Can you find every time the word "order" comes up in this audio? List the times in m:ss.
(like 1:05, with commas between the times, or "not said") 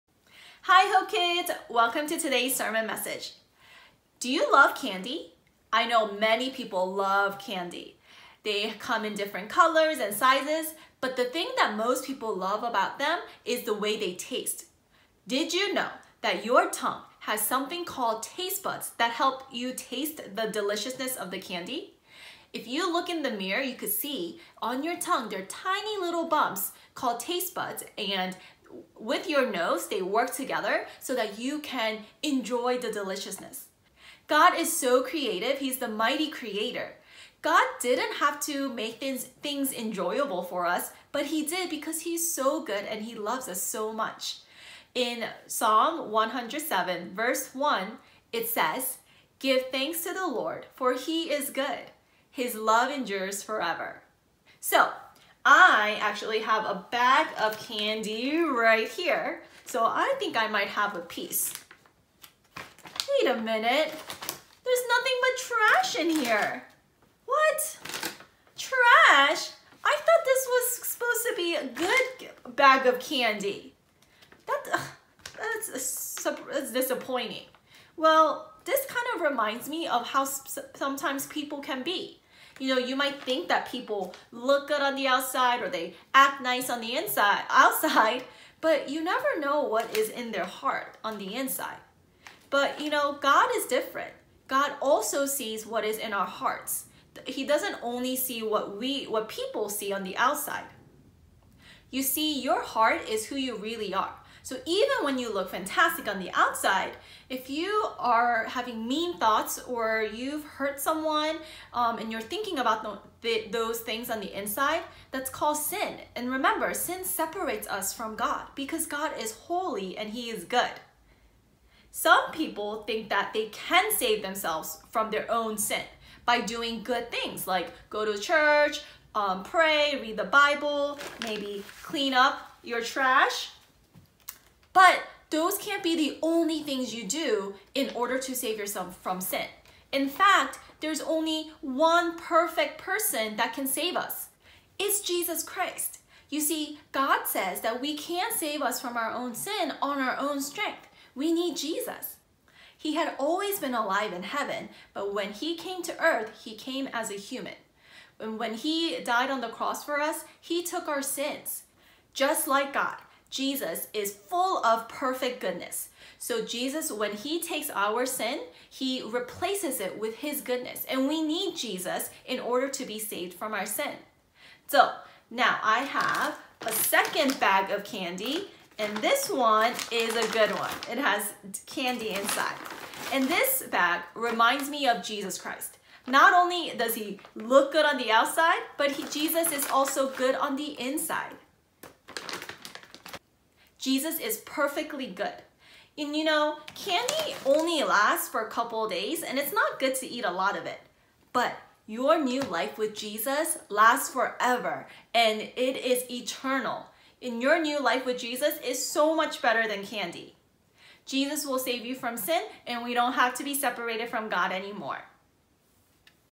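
2:17, 2:52.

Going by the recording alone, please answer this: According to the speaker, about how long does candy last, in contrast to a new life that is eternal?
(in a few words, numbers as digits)
a couple days.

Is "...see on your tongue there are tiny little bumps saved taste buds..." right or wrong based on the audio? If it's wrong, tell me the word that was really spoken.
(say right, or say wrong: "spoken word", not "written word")
wrong: "called", not "saved".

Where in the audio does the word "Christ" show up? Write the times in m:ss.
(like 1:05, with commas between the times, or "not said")
2:25, 3:05.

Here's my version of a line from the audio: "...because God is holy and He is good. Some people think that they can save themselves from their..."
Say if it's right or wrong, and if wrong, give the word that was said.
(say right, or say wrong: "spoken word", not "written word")
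right.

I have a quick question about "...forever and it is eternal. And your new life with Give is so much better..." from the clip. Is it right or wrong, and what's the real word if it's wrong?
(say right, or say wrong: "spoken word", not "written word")
wrong: "Jesus", not "Give".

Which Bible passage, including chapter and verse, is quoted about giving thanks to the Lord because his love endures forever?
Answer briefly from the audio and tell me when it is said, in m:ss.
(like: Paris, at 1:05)
Psalm 107:1, at 0:45.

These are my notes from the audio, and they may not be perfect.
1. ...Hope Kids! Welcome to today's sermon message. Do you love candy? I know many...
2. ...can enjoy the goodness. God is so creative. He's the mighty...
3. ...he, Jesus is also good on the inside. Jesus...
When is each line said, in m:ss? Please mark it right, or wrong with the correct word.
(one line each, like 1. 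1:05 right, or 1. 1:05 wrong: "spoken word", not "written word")
1. 0:00 right
2. 0:31 wrong: "deliciousness", not "goodness"
3. 3:08 right.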